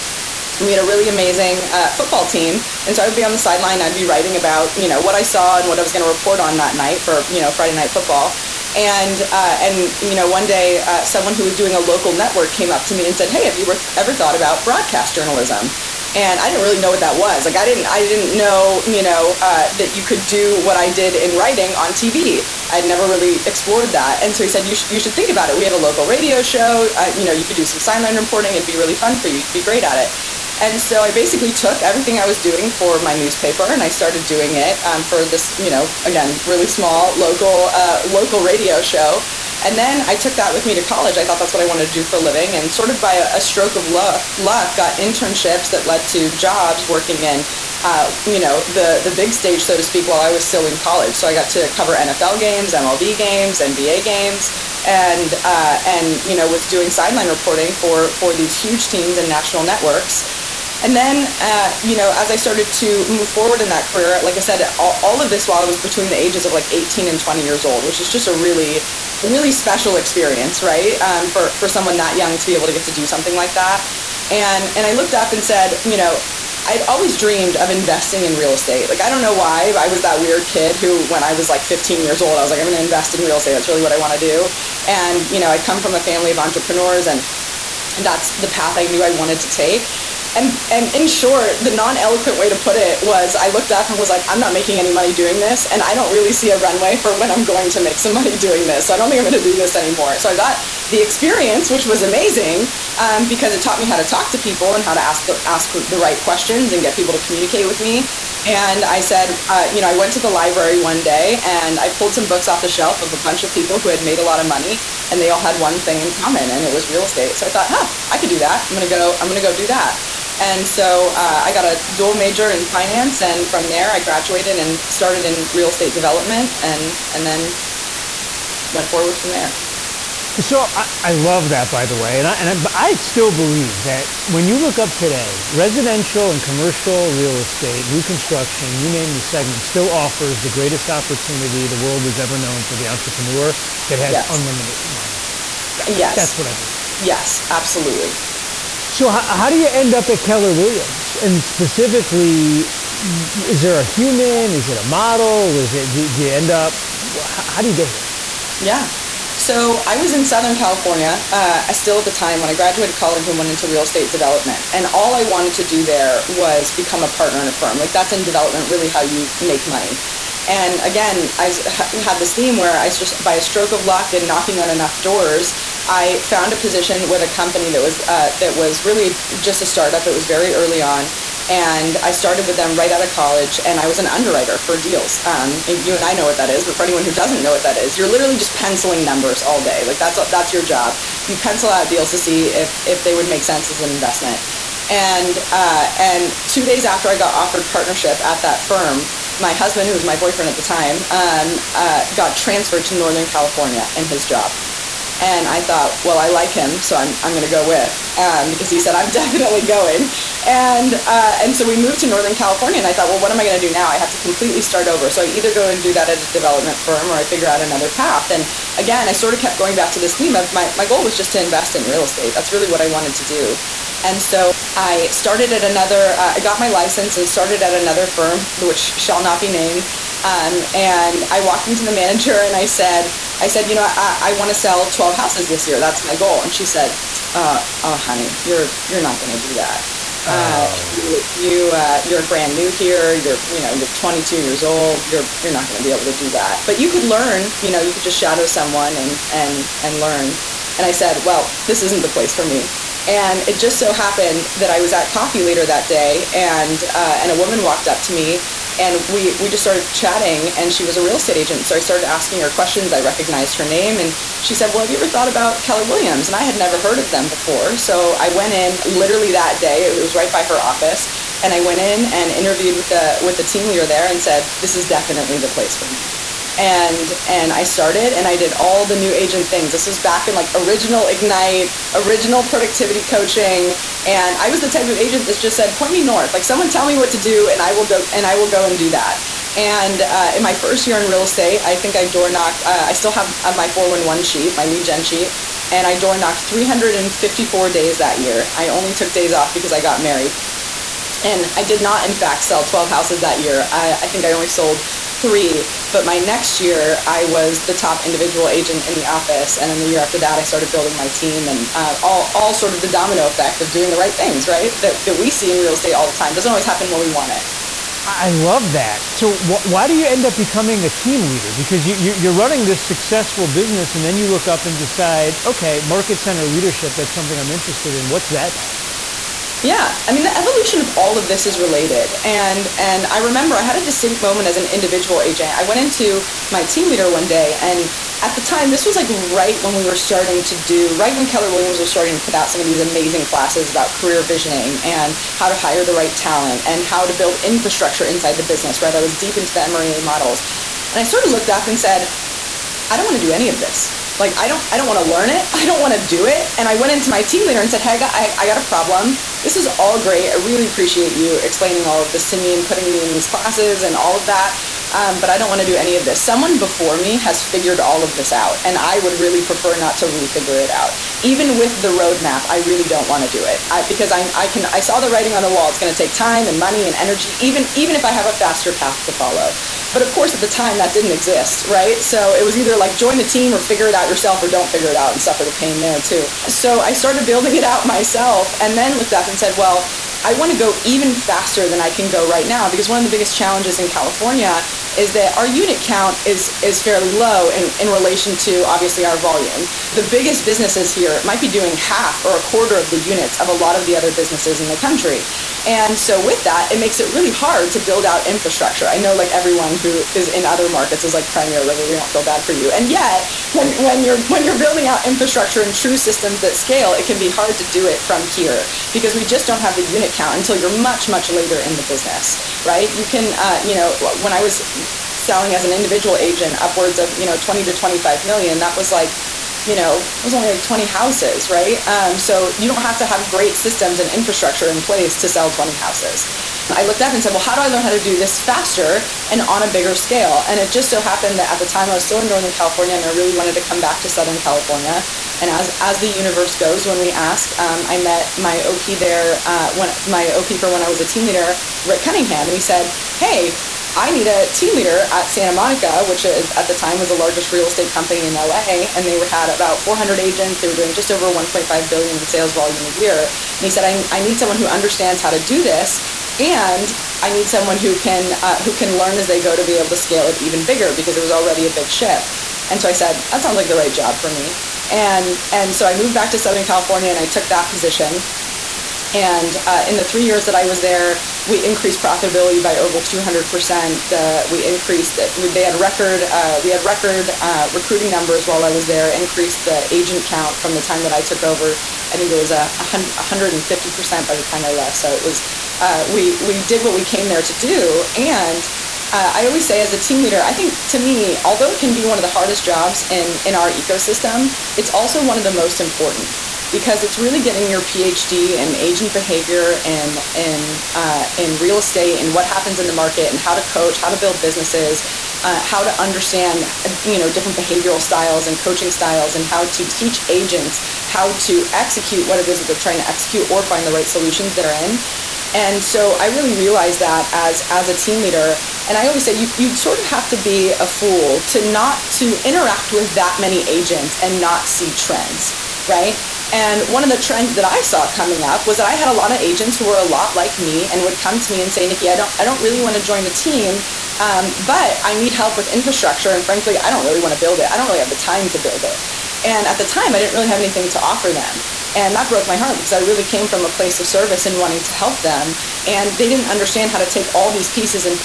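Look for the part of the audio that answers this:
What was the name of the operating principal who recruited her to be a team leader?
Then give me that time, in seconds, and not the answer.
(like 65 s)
451 s.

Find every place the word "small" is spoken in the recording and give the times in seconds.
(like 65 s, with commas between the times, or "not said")
36 s.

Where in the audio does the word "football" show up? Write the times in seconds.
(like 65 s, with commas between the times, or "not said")
1 s, 7 s.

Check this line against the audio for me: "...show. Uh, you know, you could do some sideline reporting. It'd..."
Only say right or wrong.
right.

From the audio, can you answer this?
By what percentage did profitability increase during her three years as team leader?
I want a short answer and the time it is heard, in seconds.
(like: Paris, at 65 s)
200 percent, at 482 s.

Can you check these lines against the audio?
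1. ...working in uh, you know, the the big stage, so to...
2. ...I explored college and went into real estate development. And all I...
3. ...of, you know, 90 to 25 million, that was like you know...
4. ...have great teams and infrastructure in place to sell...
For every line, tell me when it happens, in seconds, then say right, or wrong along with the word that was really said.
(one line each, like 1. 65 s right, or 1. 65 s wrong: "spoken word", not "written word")
1. 46 s right
2. 162 s wrong: "graduated", not "explored"
3. 426 s wrong: "20", not "90"
4. 433 s wrong: "systems", not "teams".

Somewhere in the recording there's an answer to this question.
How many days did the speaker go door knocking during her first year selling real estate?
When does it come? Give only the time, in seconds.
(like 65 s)
296 s.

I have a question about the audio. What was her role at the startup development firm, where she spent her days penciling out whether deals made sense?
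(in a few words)
Underwriter.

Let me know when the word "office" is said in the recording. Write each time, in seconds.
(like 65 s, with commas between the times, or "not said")
270 s, 309 s.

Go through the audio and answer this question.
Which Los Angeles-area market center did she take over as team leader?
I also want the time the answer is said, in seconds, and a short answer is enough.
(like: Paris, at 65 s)
Santa Monica, at 455 s.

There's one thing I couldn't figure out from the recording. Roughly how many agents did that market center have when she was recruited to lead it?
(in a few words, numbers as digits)
400.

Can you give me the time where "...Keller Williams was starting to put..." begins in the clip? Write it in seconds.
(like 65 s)
341 s.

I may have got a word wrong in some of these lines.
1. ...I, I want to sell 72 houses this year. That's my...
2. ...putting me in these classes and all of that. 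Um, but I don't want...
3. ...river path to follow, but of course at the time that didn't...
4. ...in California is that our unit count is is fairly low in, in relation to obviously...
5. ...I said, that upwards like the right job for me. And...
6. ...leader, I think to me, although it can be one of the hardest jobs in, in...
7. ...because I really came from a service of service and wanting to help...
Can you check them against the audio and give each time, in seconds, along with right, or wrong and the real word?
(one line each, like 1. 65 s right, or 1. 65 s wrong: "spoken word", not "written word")
1. 233 s wrong: "12", not "72"
2. 362 s right
3. 378 s wrong: "faster", not "river"
4. 393 s right
5. 472 s wrong: "sounds", not "upwards"
6. 500 s right
7. 552 s wrong: "place", not "service".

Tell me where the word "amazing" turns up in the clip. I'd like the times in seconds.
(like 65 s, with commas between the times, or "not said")
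1 s, 102 s, 342 s.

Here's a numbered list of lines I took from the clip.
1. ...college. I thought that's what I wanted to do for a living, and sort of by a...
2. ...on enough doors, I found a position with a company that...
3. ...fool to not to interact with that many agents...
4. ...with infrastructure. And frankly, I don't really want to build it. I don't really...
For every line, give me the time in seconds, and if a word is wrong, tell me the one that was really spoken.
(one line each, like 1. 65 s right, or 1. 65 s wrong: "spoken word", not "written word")
1. 40 s right
2. 174 s right
3. 530 s right
4. 545 s right.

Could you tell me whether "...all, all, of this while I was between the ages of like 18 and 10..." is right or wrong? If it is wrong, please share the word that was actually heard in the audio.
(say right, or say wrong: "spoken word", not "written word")
wrong: "20", not "10".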